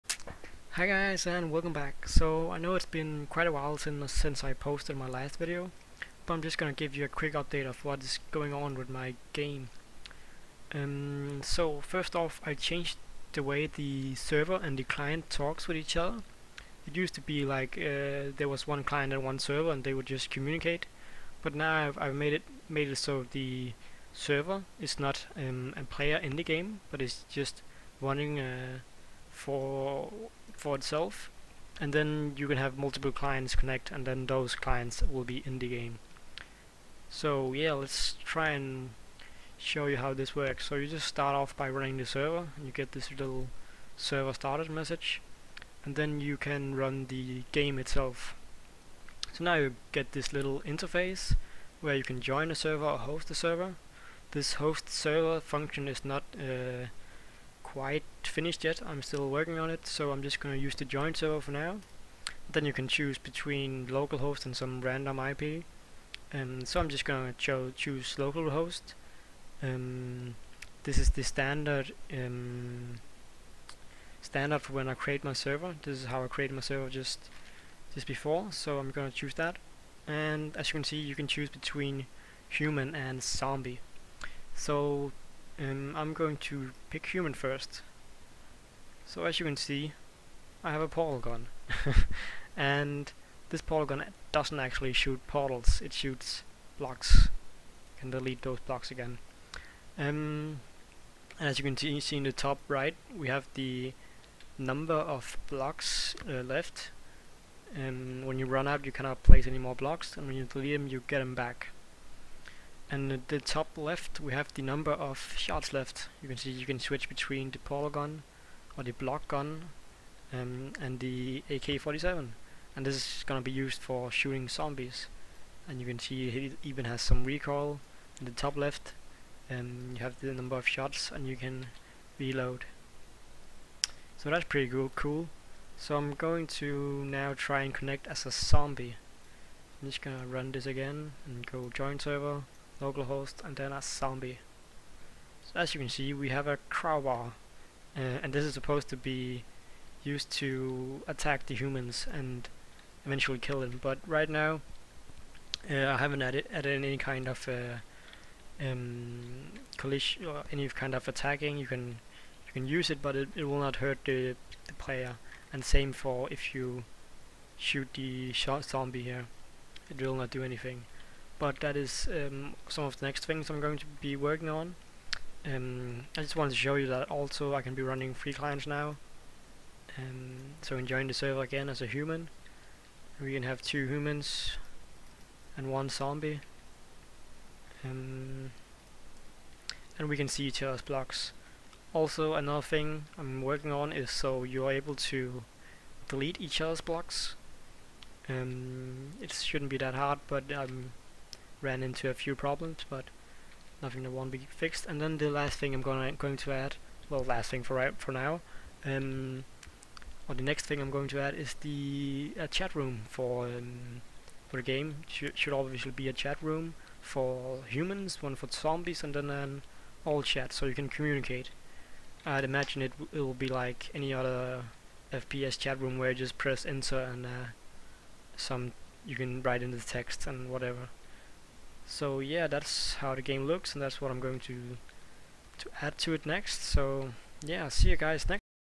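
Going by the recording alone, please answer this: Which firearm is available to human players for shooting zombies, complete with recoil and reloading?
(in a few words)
AK-47.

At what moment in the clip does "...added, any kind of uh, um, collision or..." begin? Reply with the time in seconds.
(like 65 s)
156 s.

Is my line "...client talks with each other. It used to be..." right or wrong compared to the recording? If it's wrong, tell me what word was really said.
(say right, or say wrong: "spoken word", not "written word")
right.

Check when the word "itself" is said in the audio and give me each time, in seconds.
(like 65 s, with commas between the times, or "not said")
30 s, 47 s.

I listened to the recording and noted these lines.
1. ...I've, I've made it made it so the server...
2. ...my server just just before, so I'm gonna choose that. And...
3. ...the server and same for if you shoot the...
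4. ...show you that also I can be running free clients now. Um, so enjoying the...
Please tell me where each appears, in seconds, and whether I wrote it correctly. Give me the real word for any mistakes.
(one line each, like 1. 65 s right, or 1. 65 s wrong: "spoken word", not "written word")
1. 21 s right
2. 76 s right
3. 164 s wrong: "player", not "server"
4. 176 s right.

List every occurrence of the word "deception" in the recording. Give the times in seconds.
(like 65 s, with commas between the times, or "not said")
not said.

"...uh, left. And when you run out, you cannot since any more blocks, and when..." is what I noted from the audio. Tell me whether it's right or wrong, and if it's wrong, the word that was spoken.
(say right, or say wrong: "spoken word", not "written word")
wrong: "place", not "since".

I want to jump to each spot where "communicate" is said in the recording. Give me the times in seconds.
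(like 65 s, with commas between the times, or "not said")
20 s, 220 s.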